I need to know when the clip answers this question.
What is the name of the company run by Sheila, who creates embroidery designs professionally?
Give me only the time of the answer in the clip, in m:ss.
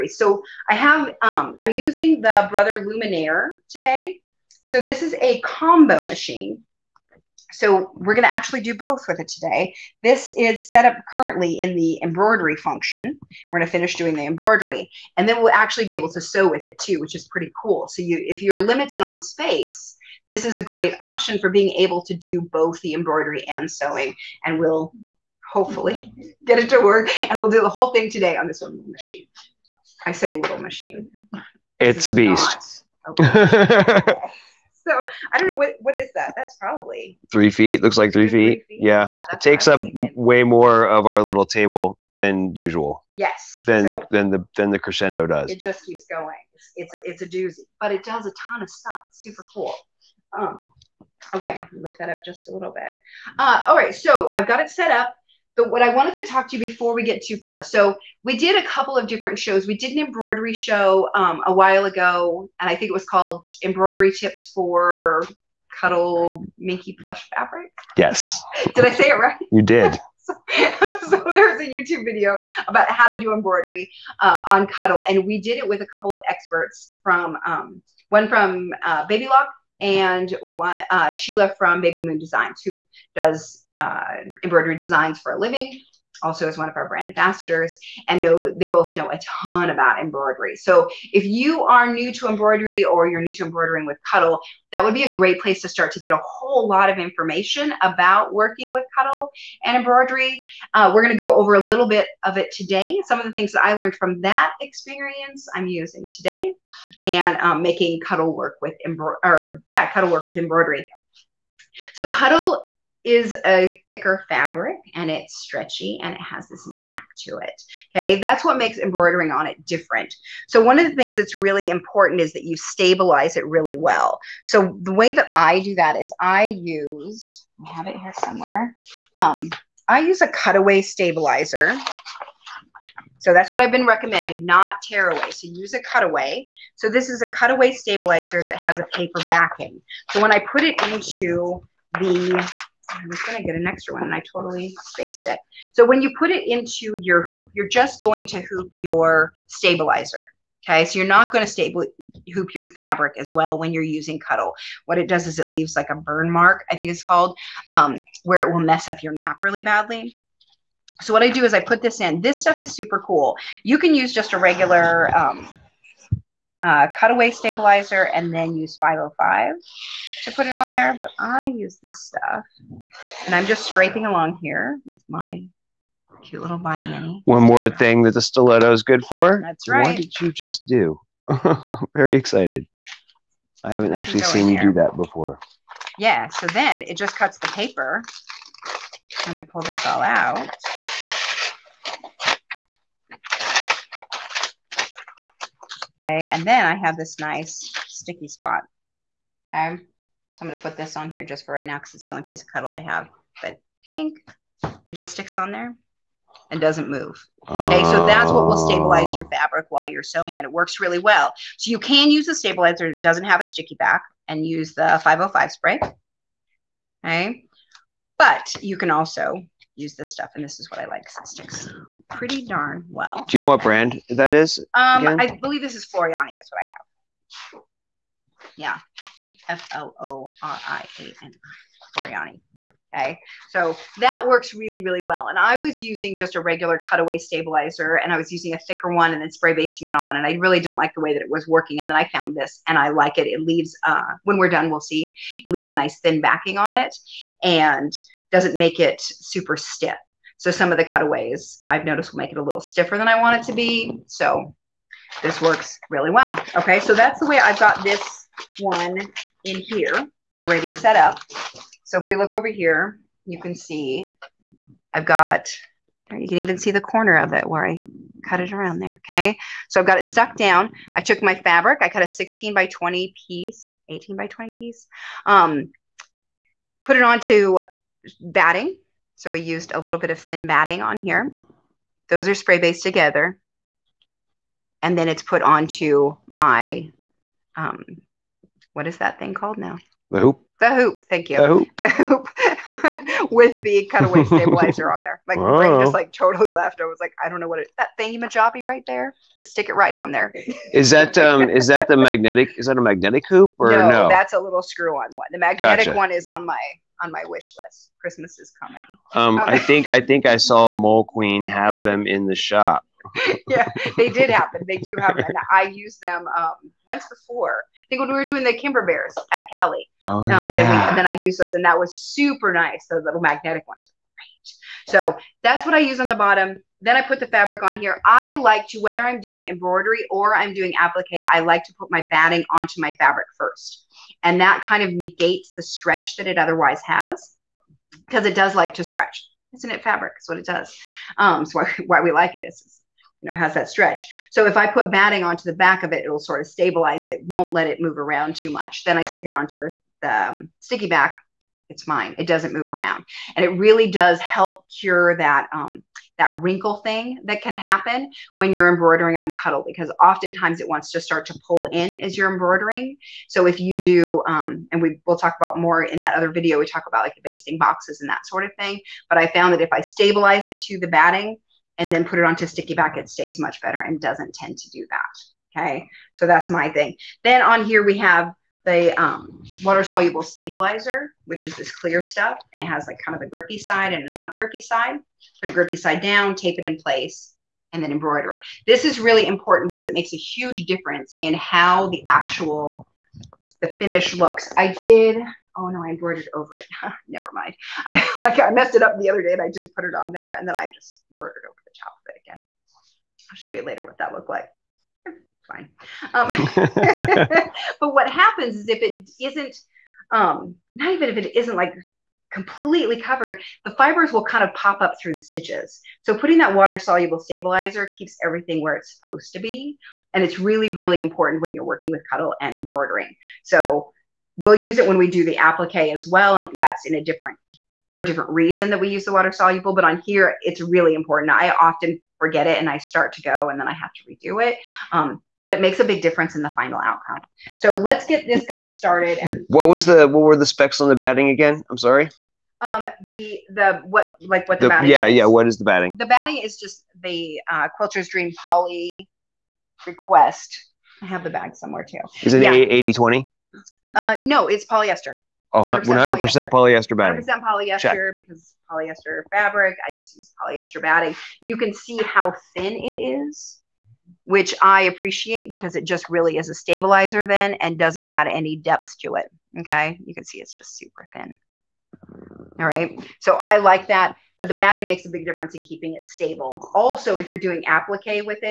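1:21.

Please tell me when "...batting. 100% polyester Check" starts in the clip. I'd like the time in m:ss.
7:36.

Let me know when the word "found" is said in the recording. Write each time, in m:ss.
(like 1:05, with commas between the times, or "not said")
4:02, 6:09.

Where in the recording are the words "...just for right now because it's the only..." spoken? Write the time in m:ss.
3:21.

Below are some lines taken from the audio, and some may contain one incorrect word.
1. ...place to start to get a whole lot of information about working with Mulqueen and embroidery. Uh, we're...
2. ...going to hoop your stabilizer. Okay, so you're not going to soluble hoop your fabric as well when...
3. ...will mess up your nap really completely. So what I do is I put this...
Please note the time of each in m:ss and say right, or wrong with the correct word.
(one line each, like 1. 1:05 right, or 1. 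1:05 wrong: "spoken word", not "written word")
1. 1:35 wrong: "Cuddle", not "Mulqueen"
2. 2:27 wrong: "stable", not "soluble"
3. 2:38 wrong: "badly", not "completely".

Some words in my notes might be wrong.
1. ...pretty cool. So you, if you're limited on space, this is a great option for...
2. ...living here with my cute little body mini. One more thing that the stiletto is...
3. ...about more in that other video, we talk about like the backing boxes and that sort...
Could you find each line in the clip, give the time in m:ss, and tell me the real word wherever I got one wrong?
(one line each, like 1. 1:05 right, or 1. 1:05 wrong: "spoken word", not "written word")
1. 0:17 right
2. 2:54 wrong: "along", not "living"
3. 6:05 wrong: "basting", not "backing".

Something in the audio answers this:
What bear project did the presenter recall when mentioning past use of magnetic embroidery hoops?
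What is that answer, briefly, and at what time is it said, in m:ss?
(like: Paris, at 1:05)
Kimber Bears, at 5:18.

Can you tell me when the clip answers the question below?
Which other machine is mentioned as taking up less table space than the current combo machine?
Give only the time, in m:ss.
0:44.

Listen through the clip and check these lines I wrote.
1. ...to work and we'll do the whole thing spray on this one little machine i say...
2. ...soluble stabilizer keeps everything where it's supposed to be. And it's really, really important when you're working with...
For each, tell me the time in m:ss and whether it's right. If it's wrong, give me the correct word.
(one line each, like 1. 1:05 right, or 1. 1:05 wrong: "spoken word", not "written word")
1. 0:26 wrong: "today", not "spray"
2. 6:56 right.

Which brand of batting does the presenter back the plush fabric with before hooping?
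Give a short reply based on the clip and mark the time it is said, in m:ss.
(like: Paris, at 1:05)
Quilter's Dream, at 7:27.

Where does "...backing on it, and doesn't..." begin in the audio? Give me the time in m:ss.
4:06.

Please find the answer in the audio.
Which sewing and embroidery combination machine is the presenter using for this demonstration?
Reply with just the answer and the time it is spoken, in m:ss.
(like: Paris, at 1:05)
Brother Luminaire, at 0:02.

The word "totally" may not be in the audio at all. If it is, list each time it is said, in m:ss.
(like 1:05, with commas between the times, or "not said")
2:24, 4:56.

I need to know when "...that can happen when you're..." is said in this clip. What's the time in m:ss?
5:57.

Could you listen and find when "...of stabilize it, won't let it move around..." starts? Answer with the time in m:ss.
5:46.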